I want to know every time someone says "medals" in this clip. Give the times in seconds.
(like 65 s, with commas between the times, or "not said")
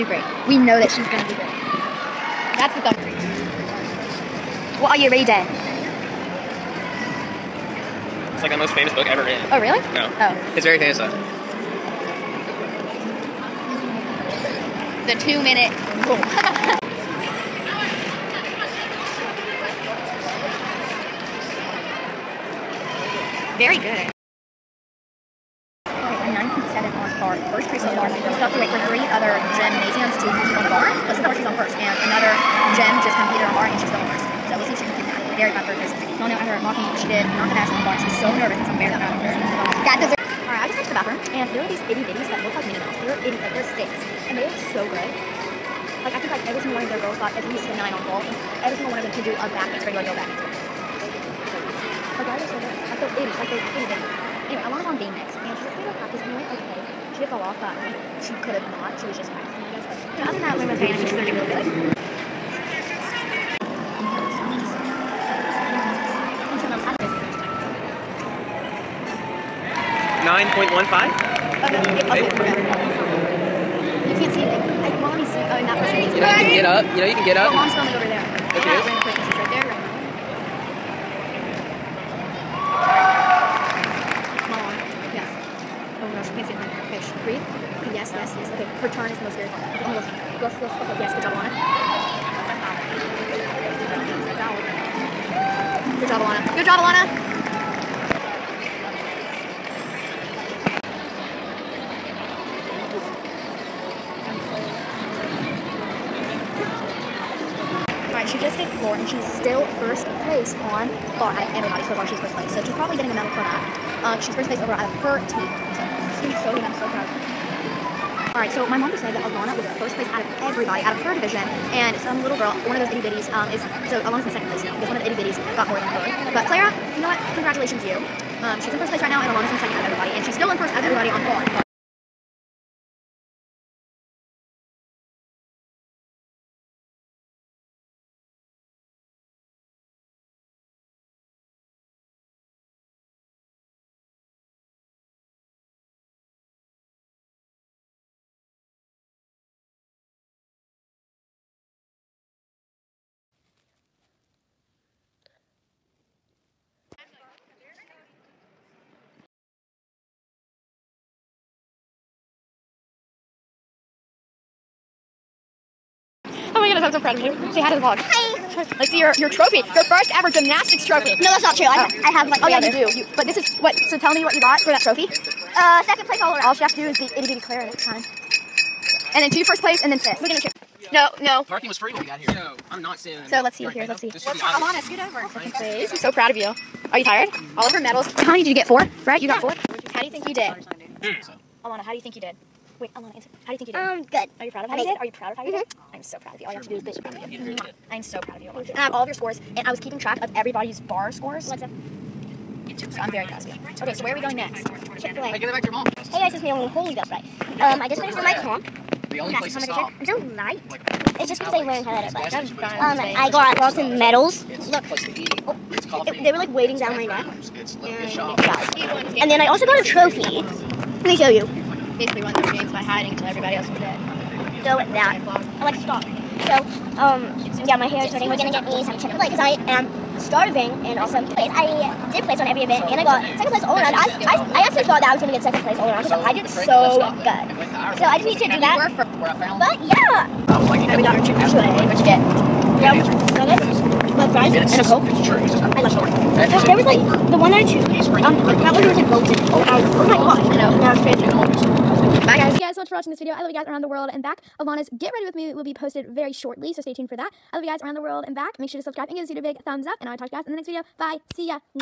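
187 s, 213 s.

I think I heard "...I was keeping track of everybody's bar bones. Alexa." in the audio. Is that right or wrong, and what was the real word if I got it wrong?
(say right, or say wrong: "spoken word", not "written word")
wrong: "scores", not "bones".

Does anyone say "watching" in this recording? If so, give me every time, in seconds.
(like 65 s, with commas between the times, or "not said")
252 s.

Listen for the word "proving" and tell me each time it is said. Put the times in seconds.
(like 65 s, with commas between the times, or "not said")
not said.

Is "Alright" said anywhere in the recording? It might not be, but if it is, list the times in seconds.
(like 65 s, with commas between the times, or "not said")
118 s.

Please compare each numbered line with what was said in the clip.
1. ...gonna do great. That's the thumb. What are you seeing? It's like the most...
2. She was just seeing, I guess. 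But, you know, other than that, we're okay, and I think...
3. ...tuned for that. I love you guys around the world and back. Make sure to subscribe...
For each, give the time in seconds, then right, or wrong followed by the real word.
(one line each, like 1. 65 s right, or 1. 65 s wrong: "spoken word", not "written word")
1. 1 s wrong: "reading", not "seeing"
2. 58 s wrong: "practicing", not "seeing"
3. 256 s right.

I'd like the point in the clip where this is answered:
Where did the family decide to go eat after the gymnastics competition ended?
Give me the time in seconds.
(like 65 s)
204 s.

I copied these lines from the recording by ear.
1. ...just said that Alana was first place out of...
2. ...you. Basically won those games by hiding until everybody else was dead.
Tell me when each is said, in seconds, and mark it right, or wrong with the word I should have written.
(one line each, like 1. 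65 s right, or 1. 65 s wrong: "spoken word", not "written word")
1. 118 s right
2. 221 s right.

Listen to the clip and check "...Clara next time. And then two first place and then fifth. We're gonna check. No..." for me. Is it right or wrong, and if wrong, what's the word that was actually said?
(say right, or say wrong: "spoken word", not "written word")
right.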